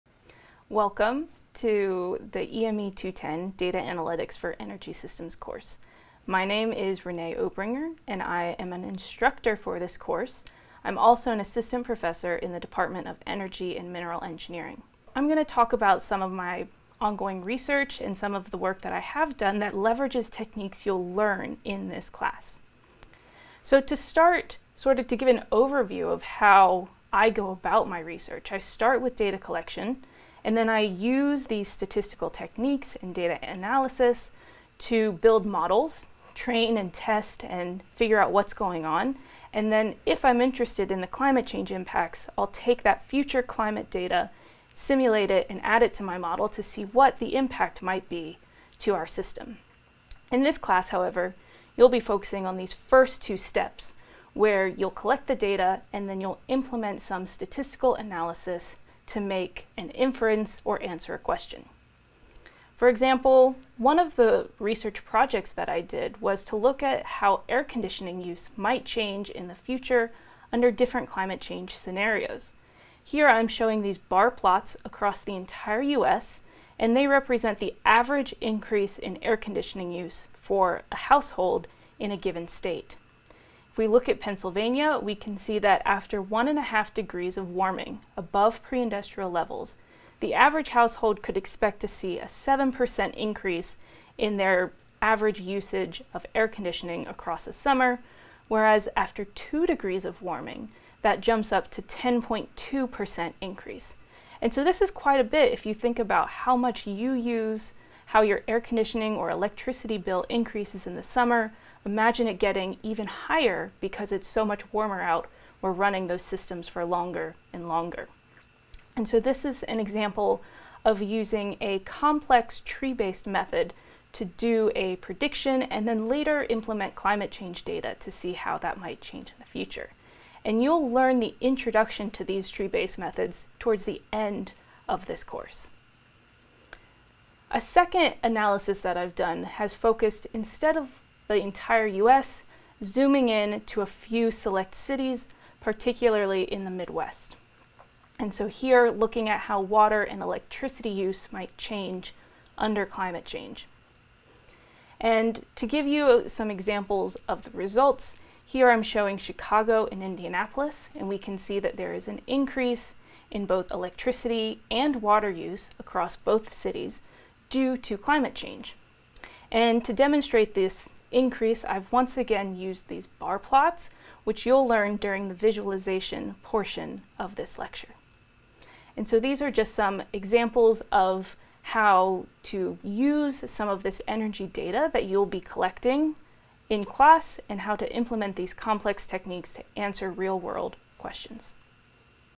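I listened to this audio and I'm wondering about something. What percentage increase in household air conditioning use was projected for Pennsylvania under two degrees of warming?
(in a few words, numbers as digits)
10.2%.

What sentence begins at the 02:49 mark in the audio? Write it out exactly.
And to demonstrate this increase, I've once again used these bar plots, which you'll learn during the visualization portion of this lecture.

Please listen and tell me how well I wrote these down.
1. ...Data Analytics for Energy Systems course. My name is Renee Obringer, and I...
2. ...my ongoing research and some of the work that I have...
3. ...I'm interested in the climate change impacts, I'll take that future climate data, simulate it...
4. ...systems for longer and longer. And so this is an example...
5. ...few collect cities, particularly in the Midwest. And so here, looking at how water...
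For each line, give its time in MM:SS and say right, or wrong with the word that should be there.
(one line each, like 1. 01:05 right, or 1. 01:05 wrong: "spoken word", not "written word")
1. 00:03 right
2. 00:16 right
3. 00:40 right
4. 01:56 right
5. 02:23 wrong: "select", not "collect".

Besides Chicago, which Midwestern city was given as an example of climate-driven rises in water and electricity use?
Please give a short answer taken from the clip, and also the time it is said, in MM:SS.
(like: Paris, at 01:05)
Indianapolis, at 02:40.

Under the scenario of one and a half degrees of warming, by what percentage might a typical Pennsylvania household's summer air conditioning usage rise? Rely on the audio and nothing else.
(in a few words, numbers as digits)
7%.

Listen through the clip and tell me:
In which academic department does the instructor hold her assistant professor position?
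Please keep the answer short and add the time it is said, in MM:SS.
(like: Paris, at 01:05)
Energy and Mineral Engineering, at 00:13.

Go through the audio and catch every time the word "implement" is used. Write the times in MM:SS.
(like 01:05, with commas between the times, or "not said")
00:56, 02:06, 03:07.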